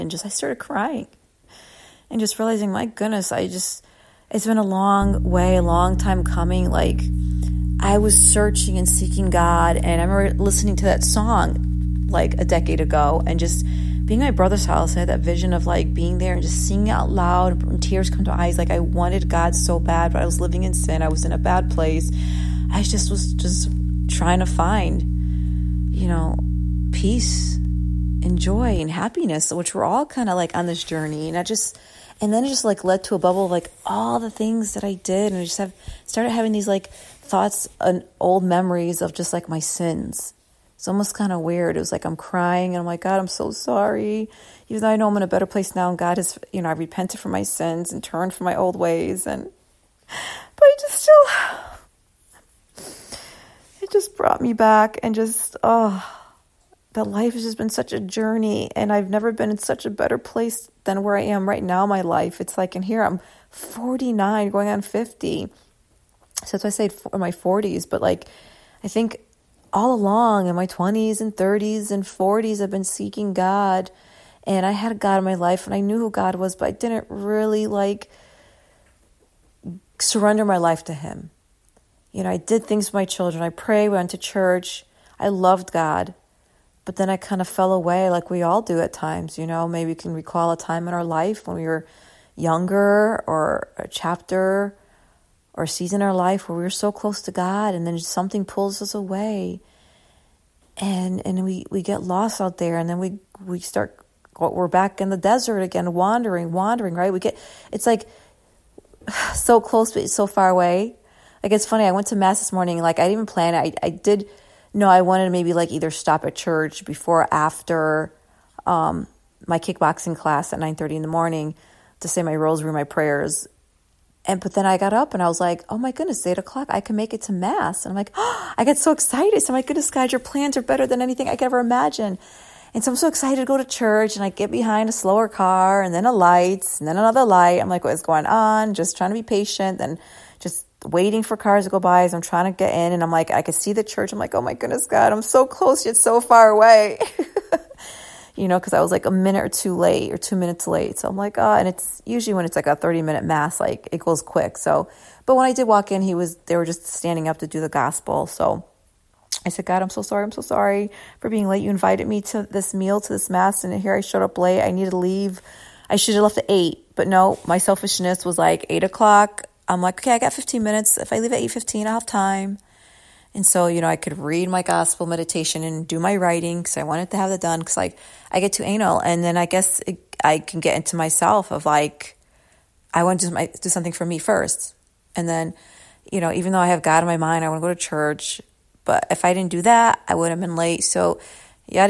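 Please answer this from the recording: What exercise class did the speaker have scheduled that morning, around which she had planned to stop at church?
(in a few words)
Kickboxing.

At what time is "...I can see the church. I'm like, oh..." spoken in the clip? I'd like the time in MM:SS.
02:23.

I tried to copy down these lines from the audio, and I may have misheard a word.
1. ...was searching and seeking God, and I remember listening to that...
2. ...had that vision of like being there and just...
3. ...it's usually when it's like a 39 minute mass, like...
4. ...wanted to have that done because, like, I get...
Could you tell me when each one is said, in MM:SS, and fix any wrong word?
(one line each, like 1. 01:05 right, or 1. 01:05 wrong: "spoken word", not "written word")
1. 00:07 right
2. 00:15 right
3. 02:31 wrong: "30", not "39"
4. 02:56 right.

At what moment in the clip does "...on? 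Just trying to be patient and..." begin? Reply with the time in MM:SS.
02:18.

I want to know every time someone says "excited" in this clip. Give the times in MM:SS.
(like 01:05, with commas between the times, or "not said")
02:08, 02:13.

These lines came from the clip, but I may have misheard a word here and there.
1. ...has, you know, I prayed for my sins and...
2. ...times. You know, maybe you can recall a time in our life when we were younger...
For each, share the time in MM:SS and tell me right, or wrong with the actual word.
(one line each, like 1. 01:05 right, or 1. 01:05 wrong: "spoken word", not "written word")
1. 00:46 wrong: "repented", not "prayed"
2. 01:28 right.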